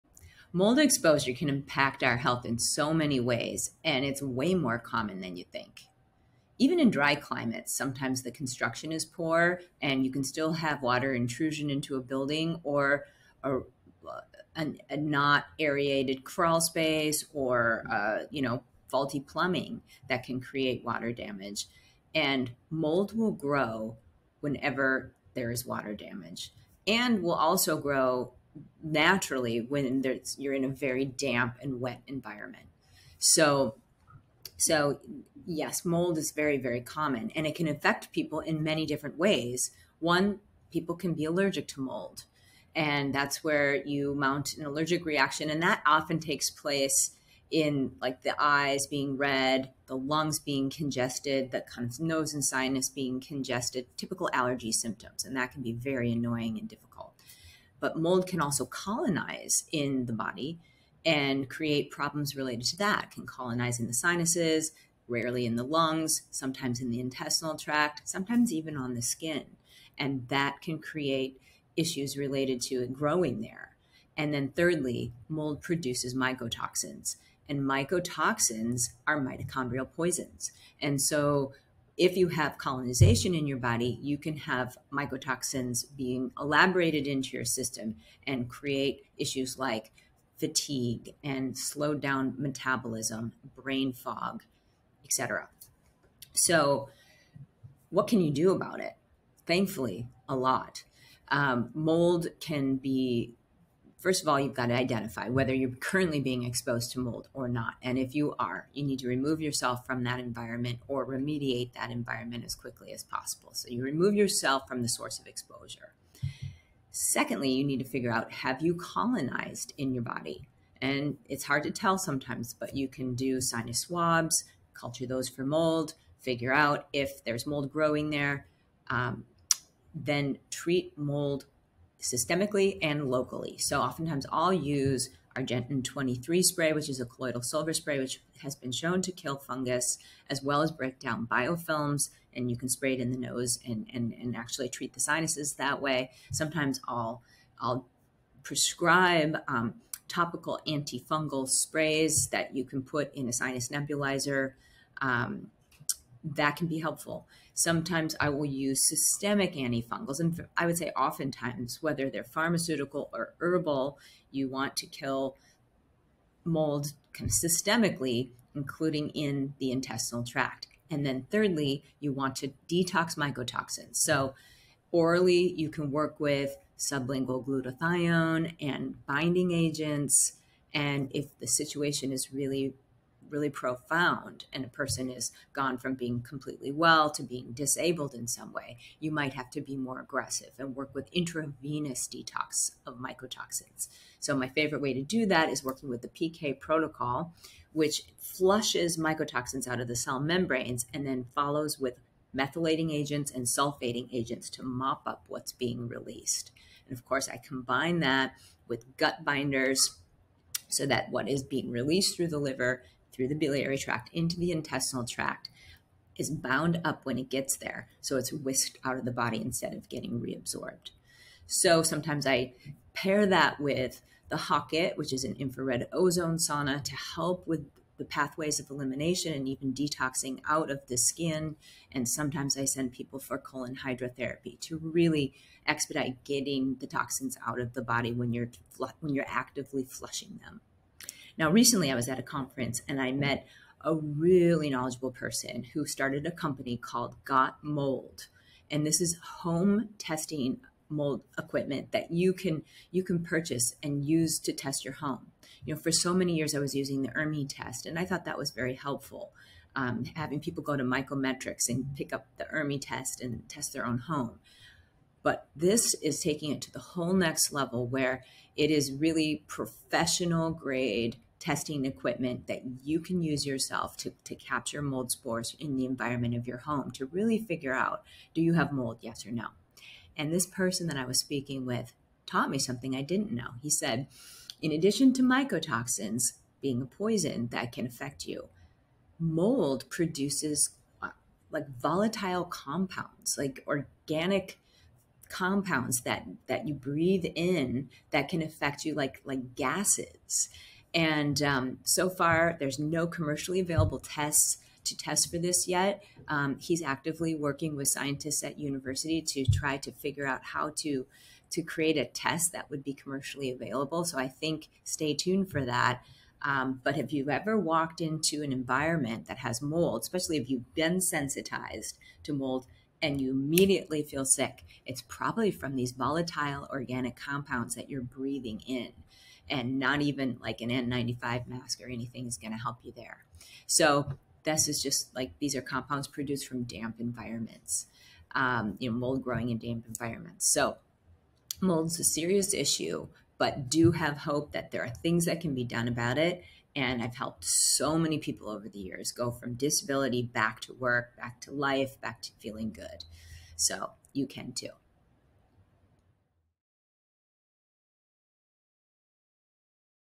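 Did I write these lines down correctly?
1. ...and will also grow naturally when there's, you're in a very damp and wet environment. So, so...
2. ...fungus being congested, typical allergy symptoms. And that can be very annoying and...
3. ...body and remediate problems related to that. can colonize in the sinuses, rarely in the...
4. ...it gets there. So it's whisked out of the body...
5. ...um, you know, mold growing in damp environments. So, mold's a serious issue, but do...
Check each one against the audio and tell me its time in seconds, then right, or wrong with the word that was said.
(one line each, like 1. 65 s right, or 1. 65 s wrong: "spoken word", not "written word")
1. 26 s right
2. 52 s wrong: "sinus", not "fungus"
3. 60 s wrong: "create", not "remediate"
4. 217 s right
5. 338 s right.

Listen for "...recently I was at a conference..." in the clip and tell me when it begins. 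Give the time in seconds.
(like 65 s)
241 s.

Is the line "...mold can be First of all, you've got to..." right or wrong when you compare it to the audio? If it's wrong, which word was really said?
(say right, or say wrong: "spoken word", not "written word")
right.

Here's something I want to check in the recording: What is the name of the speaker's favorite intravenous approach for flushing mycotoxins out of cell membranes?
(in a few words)
PK protocol.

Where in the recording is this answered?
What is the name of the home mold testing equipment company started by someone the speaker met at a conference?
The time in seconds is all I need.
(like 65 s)
247 s.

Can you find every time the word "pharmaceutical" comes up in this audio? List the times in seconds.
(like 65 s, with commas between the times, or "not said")
162 s.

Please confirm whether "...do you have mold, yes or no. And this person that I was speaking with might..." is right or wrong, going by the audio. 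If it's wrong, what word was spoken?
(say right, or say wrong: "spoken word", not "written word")
wrong: "taught", not "might".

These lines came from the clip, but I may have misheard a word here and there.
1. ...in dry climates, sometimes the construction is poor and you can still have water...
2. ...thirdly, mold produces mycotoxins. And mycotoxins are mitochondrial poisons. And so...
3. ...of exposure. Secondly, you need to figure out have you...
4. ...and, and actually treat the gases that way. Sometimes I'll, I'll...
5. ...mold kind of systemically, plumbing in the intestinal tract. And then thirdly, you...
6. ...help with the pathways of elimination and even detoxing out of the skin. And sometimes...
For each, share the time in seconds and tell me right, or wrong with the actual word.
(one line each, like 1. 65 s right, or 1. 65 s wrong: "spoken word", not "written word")
1. 6 s right
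2. 74 s right
3. 115 s right
4. 143 s wrong: "sinuses", not "gases"
5. 166 s wrong: "including", not "plumbing"
6. 227 s right.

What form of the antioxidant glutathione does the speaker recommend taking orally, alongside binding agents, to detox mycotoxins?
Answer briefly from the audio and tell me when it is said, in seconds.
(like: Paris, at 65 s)
sublingual, at 176 s.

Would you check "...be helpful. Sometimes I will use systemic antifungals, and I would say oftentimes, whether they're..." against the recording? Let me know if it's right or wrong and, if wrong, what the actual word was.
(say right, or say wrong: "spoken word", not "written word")
right.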